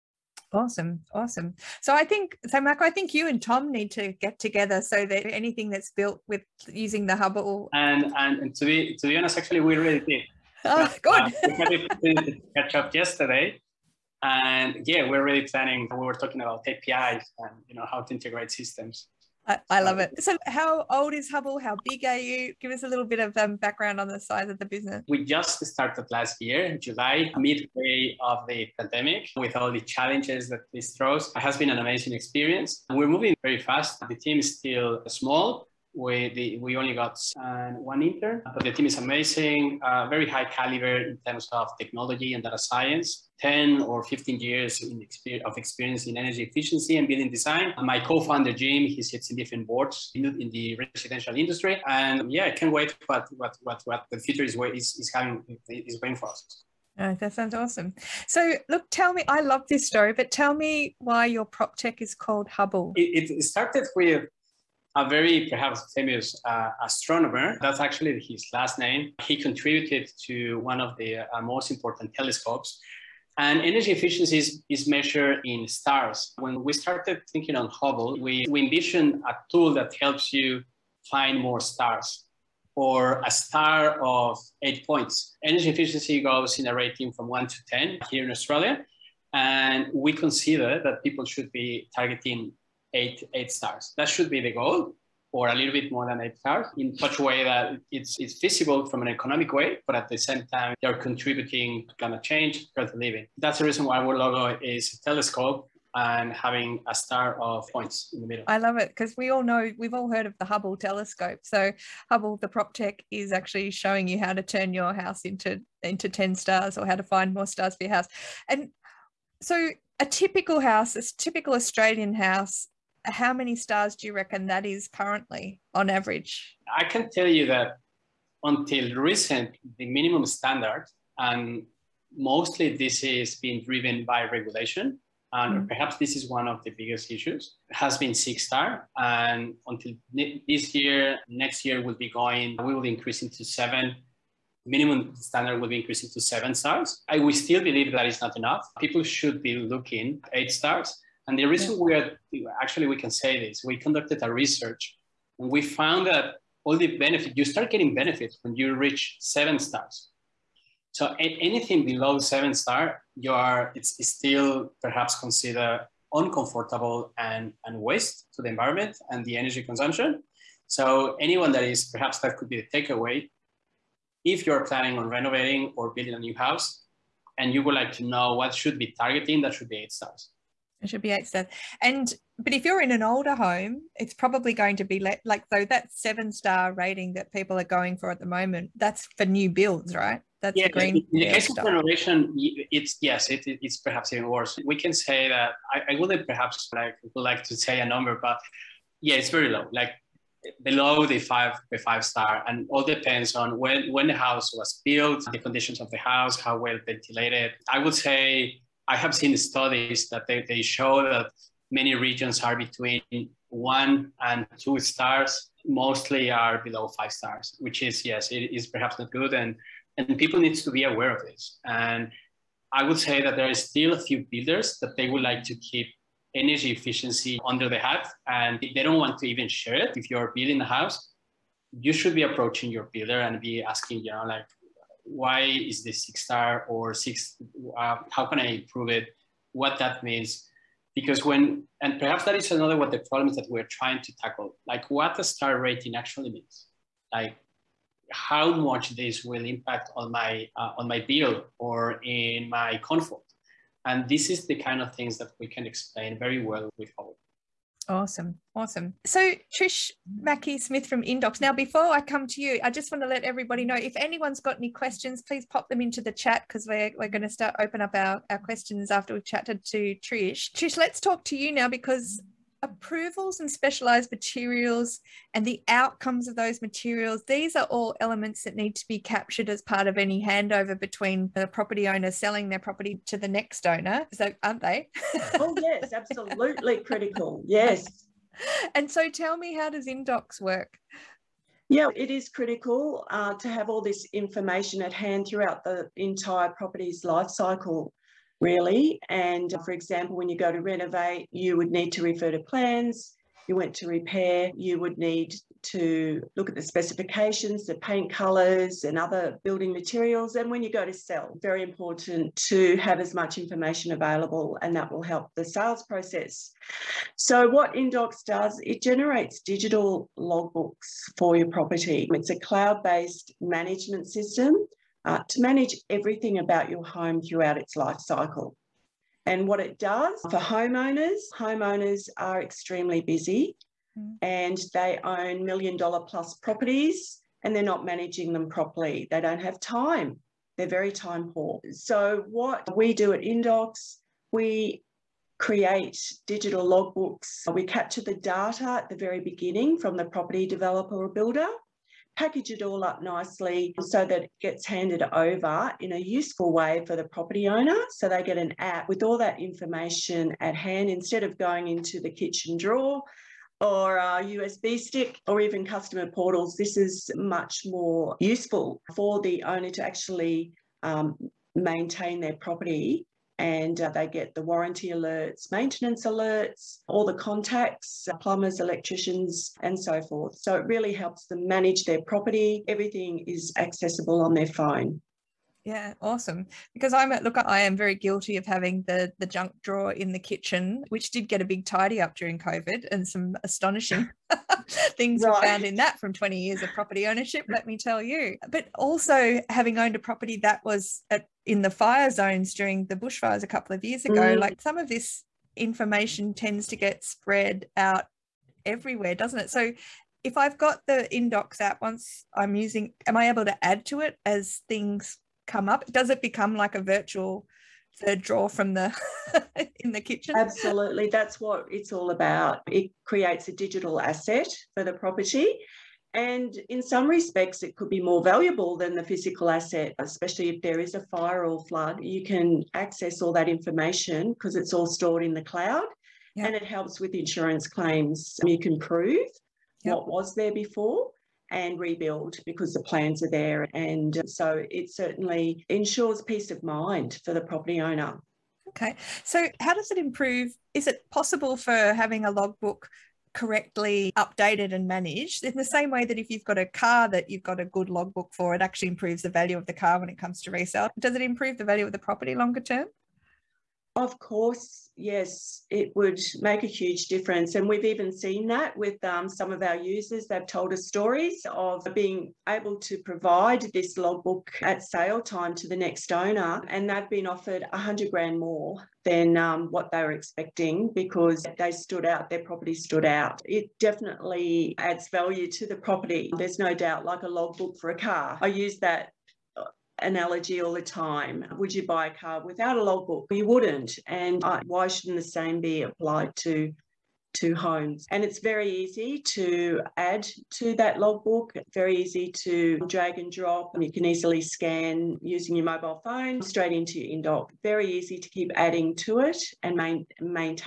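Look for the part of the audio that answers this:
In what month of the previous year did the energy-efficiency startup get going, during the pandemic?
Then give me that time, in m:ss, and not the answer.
0:26.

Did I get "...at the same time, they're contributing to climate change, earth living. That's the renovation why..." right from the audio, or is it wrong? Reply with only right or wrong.
wrong.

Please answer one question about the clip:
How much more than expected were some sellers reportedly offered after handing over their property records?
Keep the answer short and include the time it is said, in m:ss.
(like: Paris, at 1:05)
$100,000, at 7:57.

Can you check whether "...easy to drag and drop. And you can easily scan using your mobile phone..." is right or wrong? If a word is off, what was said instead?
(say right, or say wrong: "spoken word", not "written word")
right.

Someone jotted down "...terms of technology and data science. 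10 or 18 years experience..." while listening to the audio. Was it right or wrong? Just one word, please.
wrong.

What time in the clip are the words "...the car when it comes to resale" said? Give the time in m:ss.
7:39.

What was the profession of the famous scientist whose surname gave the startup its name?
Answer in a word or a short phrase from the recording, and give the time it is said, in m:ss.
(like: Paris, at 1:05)
Astronomer, at 1:06.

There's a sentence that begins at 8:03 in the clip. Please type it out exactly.
It definitely adds value to the property.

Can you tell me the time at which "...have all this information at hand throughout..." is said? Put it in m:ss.
4:53.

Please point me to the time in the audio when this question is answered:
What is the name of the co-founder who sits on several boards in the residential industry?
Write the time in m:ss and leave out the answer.
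0:48.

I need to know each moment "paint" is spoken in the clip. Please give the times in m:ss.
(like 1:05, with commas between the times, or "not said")
5:07.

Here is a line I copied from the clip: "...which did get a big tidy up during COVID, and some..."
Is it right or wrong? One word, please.
right.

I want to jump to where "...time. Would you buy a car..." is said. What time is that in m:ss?
8:10.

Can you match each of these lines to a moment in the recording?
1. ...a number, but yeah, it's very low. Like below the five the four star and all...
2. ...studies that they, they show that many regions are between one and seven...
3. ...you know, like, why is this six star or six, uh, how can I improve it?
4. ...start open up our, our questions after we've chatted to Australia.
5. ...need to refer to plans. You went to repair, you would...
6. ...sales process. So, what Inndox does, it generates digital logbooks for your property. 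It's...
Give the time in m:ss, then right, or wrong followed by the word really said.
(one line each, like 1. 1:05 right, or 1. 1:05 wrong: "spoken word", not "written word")
1. 3:17 wrong: "five", not "four"
2. 3:29 wrong: "two", not "seven"
3. 3:54 right
4. 4:27 wrong: "Trish", not "Australia"
5. 5:01 right
6. 5:15 right.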